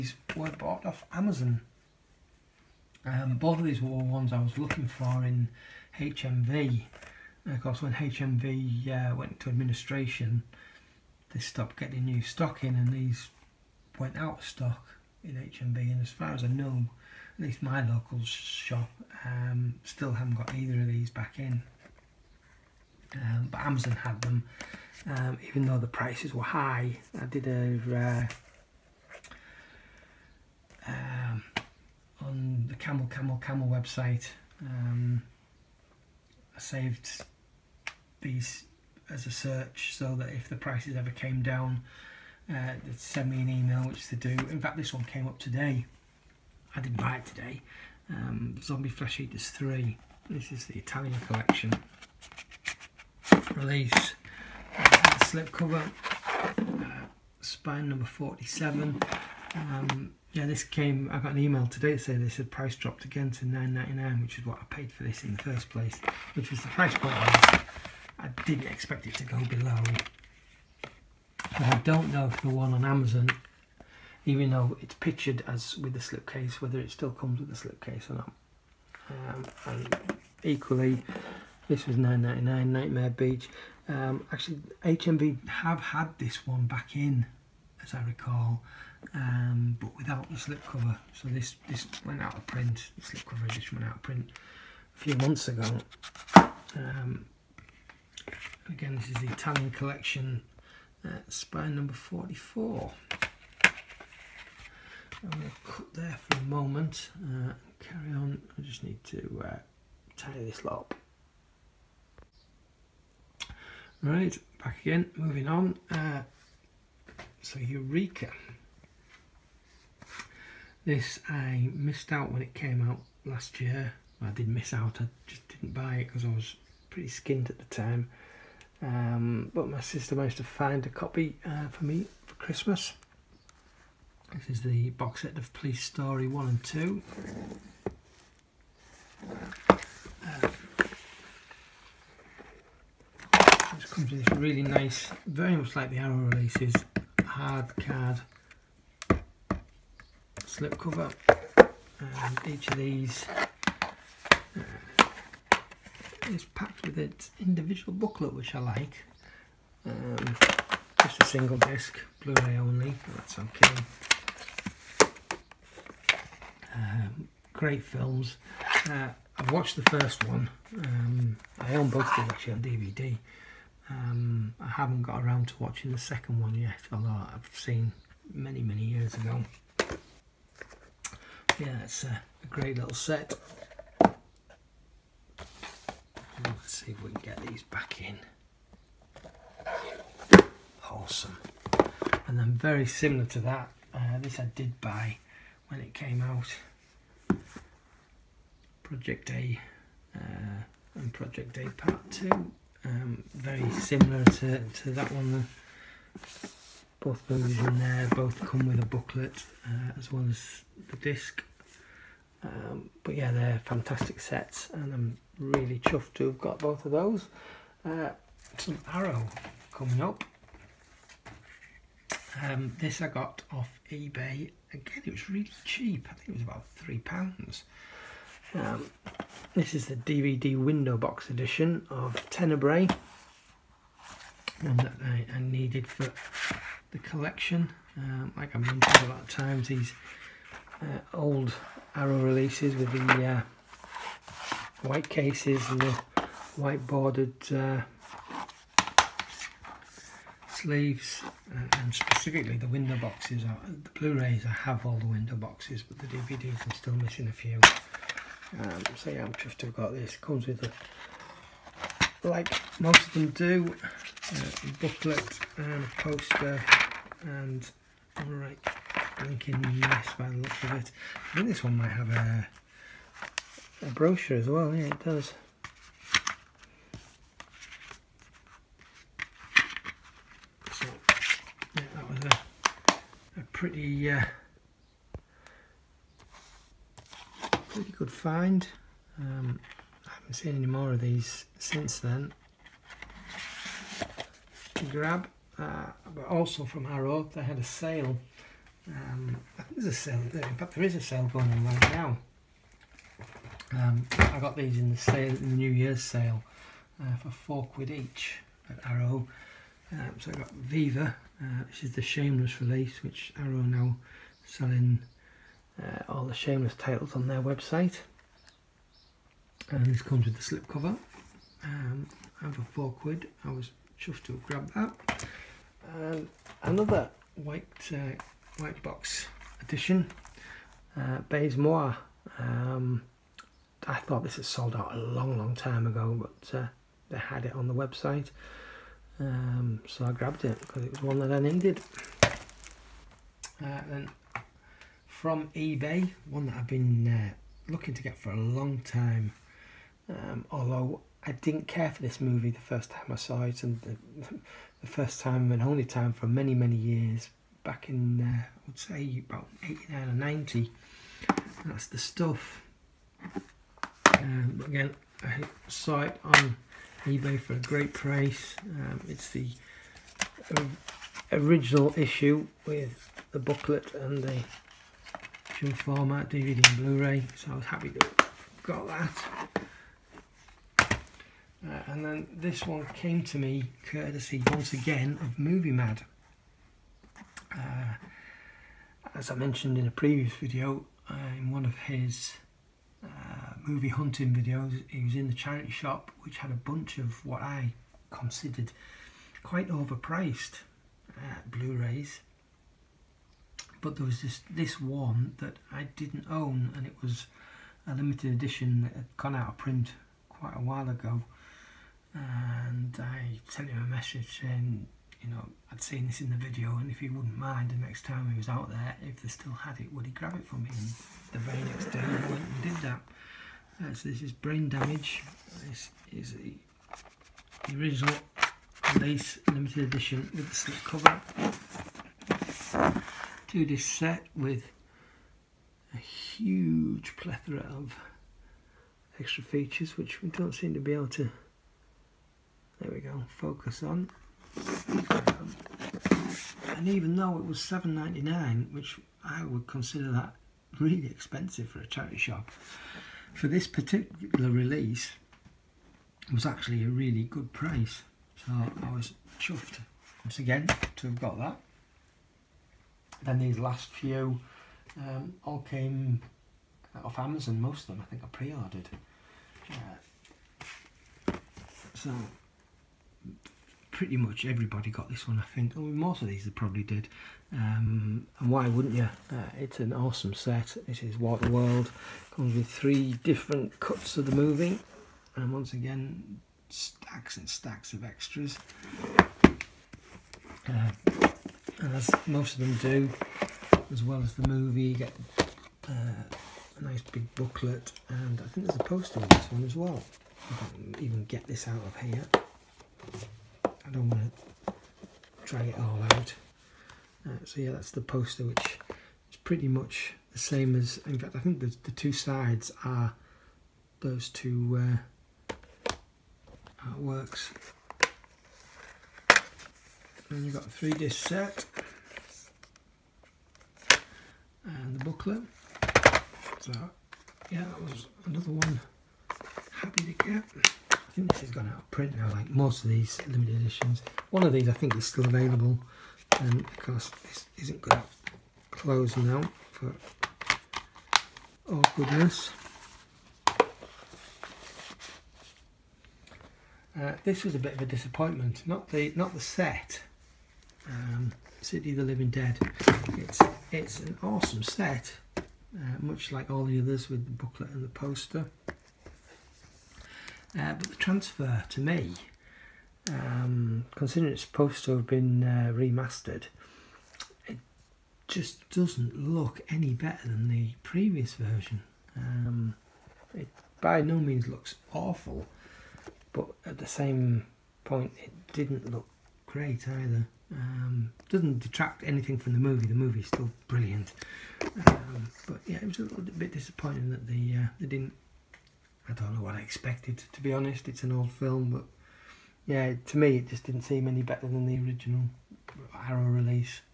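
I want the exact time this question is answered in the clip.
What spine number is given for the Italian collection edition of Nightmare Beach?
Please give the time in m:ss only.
1:41.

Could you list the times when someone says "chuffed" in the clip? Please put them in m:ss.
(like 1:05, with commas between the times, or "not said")
3:35, 4:19, 5:23, 7:39.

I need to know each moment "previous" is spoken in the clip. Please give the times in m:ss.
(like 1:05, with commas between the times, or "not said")
6:29, 9:30.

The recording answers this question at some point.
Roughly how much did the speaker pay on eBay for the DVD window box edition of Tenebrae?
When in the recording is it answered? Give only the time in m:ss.
3:46.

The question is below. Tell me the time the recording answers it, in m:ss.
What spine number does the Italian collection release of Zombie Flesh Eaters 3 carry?
0:58.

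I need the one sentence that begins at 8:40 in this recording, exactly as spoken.
And you've got a three disc set and the booklet.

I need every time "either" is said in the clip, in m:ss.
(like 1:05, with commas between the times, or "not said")
0:20, 9:39.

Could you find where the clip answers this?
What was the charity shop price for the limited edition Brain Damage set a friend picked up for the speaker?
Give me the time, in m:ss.
7:27.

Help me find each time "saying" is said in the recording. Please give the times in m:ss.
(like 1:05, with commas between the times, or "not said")
1:01, 6:54.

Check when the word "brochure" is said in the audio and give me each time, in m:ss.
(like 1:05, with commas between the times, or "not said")
4:33.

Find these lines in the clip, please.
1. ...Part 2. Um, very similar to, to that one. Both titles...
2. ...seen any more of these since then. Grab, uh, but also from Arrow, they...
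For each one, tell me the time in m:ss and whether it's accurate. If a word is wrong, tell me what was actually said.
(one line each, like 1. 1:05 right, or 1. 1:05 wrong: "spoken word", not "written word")
1. 3:21 wrong: "movies", not "titles"
2. 4:50 right.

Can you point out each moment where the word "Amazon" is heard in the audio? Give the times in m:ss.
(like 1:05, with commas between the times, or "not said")
0:01, 0:23, 1:12, 7:47.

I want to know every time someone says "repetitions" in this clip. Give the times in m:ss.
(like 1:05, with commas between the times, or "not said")
not said.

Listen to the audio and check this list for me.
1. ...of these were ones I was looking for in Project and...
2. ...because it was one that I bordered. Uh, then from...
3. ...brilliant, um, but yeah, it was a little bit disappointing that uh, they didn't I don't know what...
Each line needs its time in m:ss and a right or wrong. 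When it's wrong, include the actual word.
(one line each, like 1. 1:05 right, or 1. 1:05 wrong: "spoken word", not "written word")
1. 0:03 wrong: "HMV", not "Project"
2. 5:40 wrong: "needed", not "bordered"
3. 9:43 right.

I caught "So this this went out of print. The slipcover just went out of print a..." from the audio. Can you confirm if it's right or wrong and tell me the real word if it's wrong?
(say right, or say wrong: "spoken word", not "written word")
right.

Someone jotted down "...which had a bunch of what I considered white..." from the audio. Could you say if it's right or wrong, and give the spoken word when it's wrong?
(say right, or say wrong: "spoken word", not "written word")
wrong: "quite", not "white".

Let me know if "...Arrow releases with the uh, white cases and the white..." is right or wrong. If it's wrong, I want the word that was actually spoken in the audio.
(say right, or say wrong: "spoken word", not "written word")
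right.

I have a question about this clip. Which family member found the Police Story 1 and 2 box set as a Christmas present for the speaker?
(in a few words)
sister.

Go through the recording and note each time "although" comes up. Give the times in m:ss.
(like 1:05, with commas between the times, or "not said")
2:56, 5:50.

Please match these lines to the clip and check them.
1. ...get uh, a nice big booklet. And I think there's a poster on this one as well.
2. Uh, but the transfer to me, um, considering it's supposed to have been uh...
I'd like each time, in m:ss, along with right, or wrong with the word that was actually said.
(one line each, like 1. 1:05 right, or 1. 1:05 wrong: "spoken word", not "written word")
1. 8:14 right
2. 9:20 right.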